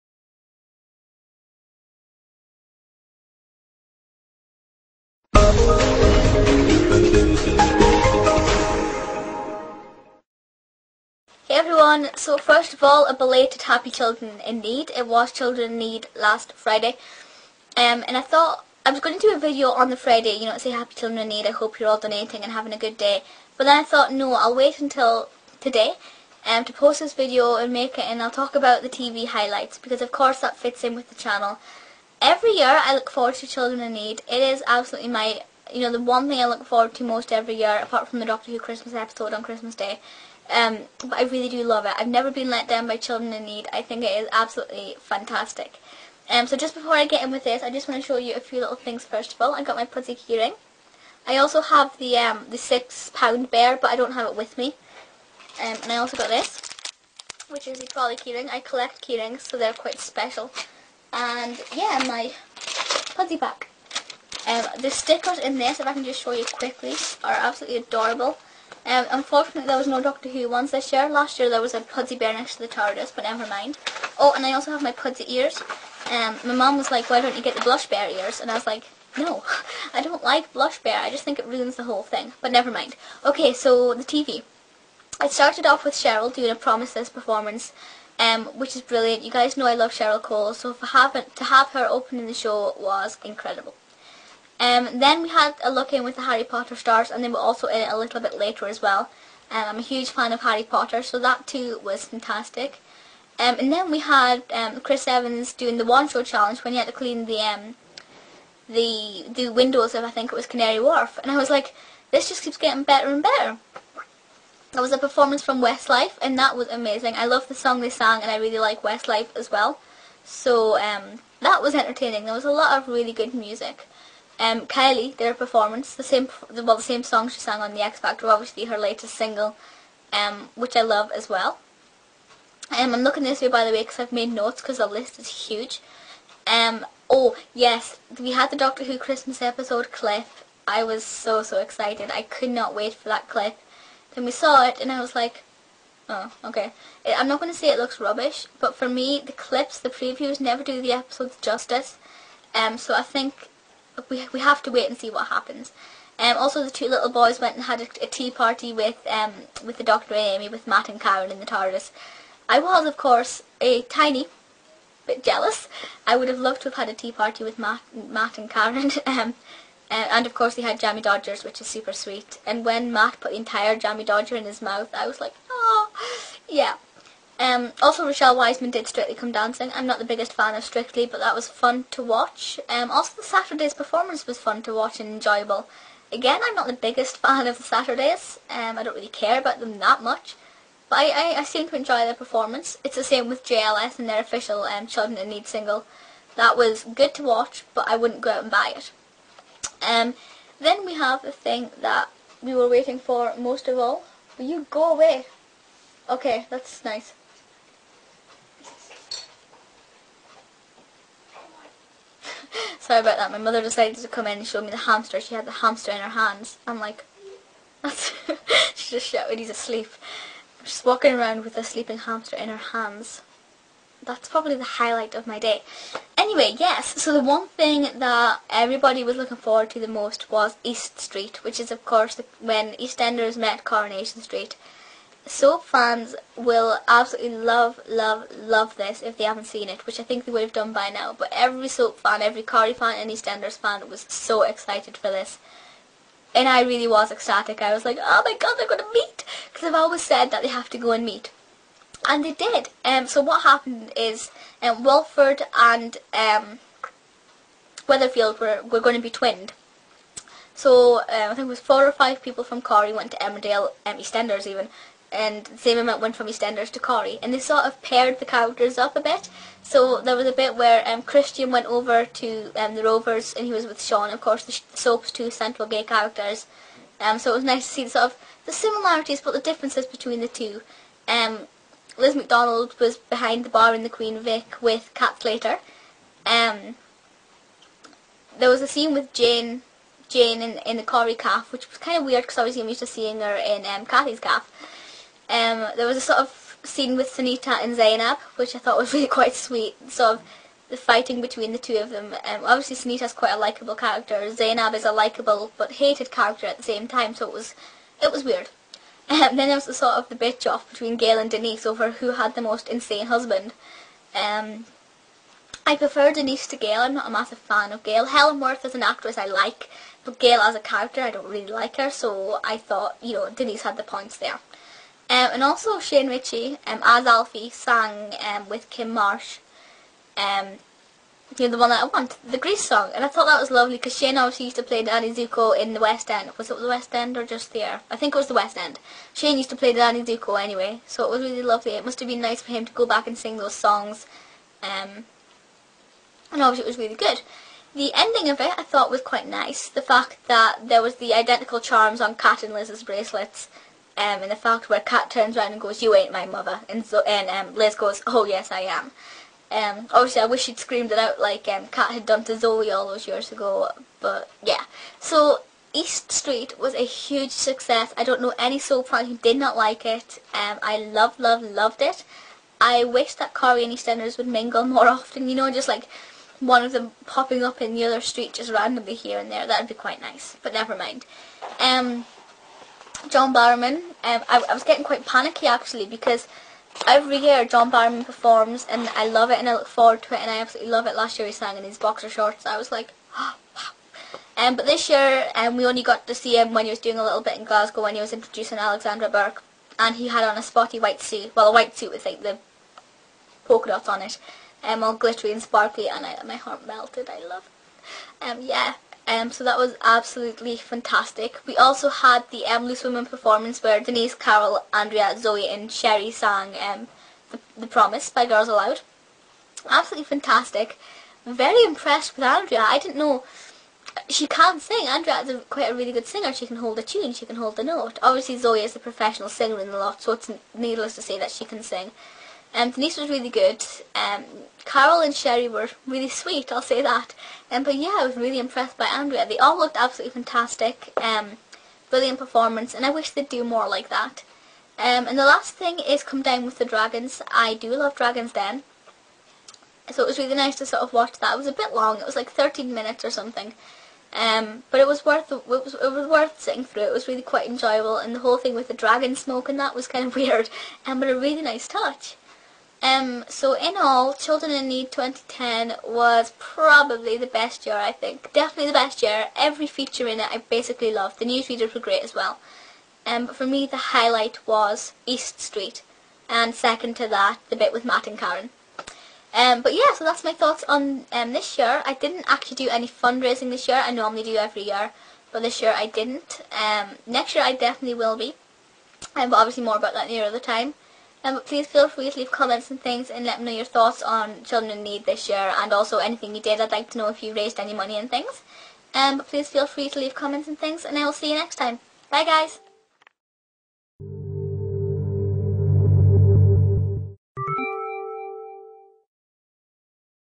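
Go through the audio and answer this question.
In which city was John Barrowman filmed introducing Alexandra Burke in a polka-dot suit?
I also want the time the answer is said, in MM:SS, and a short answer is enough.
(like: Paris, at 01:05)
Glasgow, at 06:37.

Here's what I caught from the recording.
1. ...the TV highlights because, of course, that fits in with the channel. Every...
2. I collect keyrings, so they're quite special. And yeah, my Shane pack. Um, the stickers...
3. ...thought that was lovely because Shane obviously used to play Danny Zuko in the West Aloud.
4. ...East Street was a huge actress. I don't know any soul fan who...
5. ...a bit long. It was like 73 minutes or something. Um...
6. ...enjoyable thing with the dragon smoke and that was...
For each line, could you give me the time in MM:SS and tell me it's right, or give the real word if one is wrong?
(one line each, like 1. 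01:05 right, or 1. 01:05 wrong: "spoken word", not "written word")
1. 00:28 right
2. 00:58 wrong: "Pudsey", not "Shane"
3. 05:33 wrong: "End", not "Aloud"
4. 06:05 wrong: "success", not "actress"
5. 07:31 wrong: "13", not "73"
6. 07:38 wrong: "whole", not "enjoyable".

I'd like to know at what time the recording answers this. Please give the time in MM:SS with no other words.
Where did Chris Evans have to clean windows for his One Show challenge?
01:50.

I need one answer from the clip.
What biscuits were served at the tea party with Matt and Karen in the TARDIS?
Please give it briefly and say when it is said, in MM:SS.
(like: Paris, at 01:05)
Jammy Dodgers, at 02:50.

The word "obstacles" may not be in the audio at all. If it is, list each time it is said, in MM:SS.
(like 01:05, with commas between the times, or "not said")
not said.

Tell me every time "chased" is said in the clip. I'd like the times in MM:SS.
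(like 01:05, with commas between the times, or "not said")
not said.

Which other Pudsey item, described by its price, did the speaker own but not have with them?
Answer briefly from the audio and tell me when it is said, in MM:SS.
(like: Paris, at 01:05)
six pound bear, at 00:52.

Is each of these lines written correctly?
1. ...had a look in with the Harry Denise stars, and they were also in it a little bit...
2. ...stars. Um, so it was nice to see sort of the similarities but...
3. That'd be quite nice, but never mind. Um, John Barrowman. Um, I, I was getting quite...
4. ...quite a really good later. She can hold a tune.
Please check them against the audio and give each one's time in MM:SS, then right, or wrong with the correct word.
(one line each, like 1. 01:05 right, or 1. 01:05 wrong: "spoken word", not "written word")
1. 01:35 wrong: "Potter", not "Denise"
2. 04:35 wrong: "characters", not "stars"
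3. 06:19 right
4. 07:05 wrong: "singer", not "later".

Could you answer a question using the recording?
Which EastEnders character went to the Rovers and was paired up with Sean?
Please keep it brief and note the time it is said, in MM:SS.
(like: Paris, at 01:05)
Christian, at 04:31.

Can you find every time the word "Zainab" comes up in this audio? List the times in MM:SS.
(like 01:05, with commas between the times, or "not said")
04:57, 05:04.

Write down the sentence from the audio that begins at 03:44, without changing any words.
That's probably the highlight of my day.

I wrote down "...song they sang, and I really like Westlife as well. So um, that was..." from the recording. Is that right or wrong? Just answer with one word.
right.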